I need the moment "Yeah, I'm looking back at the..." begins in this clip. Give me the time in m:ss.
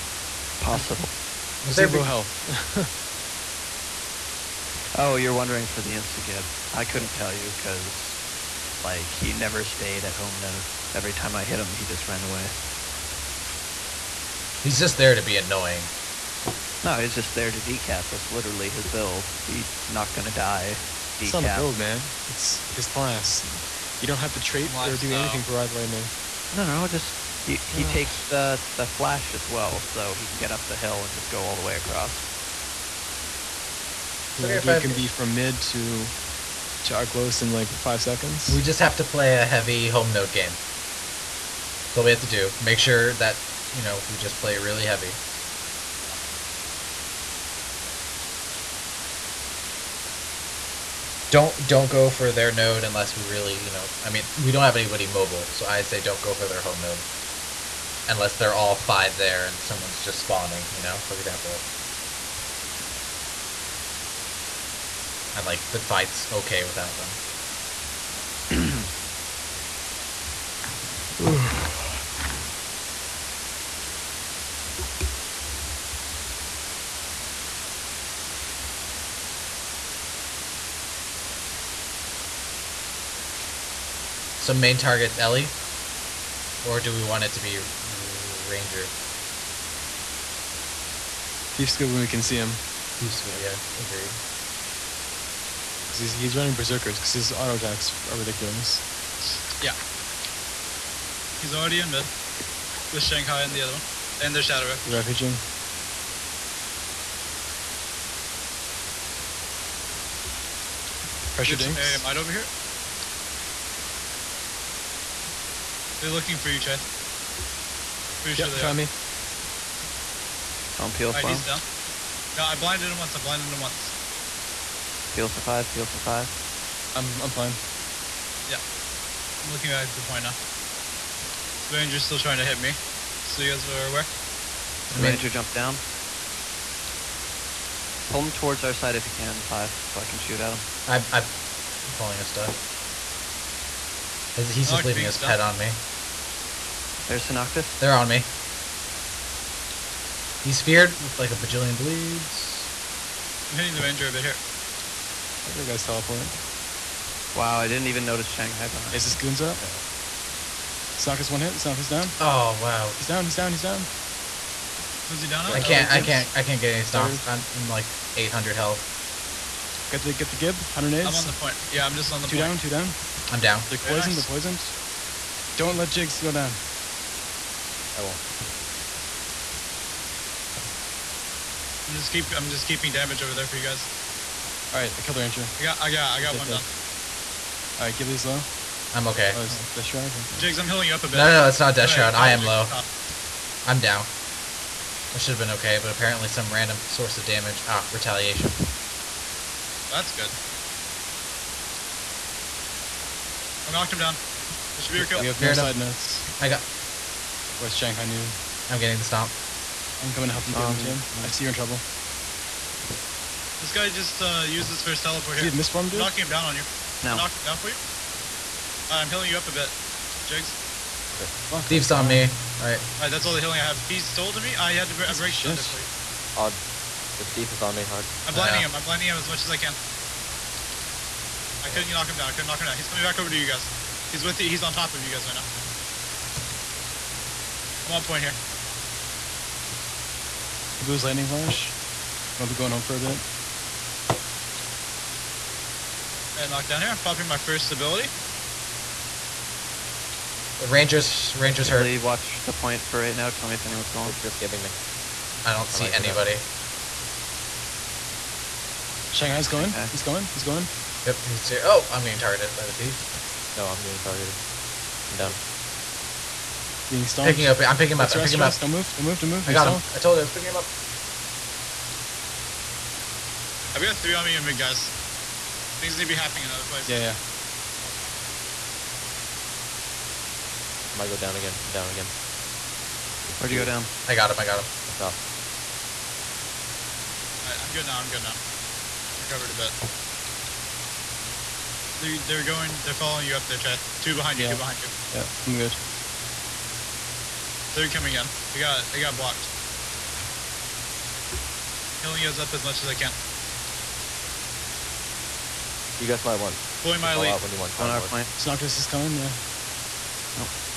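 2:08.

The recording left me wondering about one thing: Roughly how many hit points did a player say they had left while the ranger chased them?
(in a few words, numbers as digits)
800.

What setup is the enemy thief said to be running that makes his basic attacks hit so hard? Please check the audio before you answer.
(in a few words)
Berserkers.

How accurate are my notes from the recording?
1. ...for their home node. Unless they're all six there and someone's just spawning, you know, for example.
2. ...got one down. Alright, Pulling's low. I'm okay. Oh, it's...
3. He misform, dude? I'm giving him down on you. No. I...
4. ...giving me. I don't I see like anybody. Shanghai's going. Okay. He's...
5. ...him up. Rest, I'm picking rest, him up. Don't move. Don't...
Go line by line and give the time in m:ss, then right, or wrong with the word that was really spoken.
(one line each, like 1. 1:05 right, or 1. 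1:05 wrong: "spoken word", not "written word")
1. 0:56 wrong: "five", not "six"
2. 3:06 wrong: "Ghibli", not "Pulling"
3. 3:35 wrong: "knocking", not "giving"
4. 4:14 right
5. 4:27 right.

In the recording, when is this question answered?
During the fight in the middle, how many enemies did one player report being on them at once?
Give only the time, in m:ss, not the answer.
4:33.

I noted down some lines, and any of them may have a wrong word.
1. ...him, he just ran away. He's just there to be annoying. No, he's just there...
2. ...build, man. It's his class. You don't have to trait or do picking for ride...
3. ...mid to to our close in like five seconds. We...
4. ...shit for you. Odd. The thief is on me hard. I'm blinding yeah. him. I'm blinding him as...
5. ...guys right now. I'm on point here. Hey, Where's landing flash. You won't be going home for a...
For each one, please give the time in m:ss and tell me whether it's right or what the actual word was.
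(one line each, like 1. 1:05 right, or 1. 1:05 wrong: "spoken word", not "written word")
1. 0:11 right
2. 0:21 wrong: "anything", not "picking"
3. 0:35 right
4. 3:45 right
5. 3:55 wrong: "Blue", not "Where".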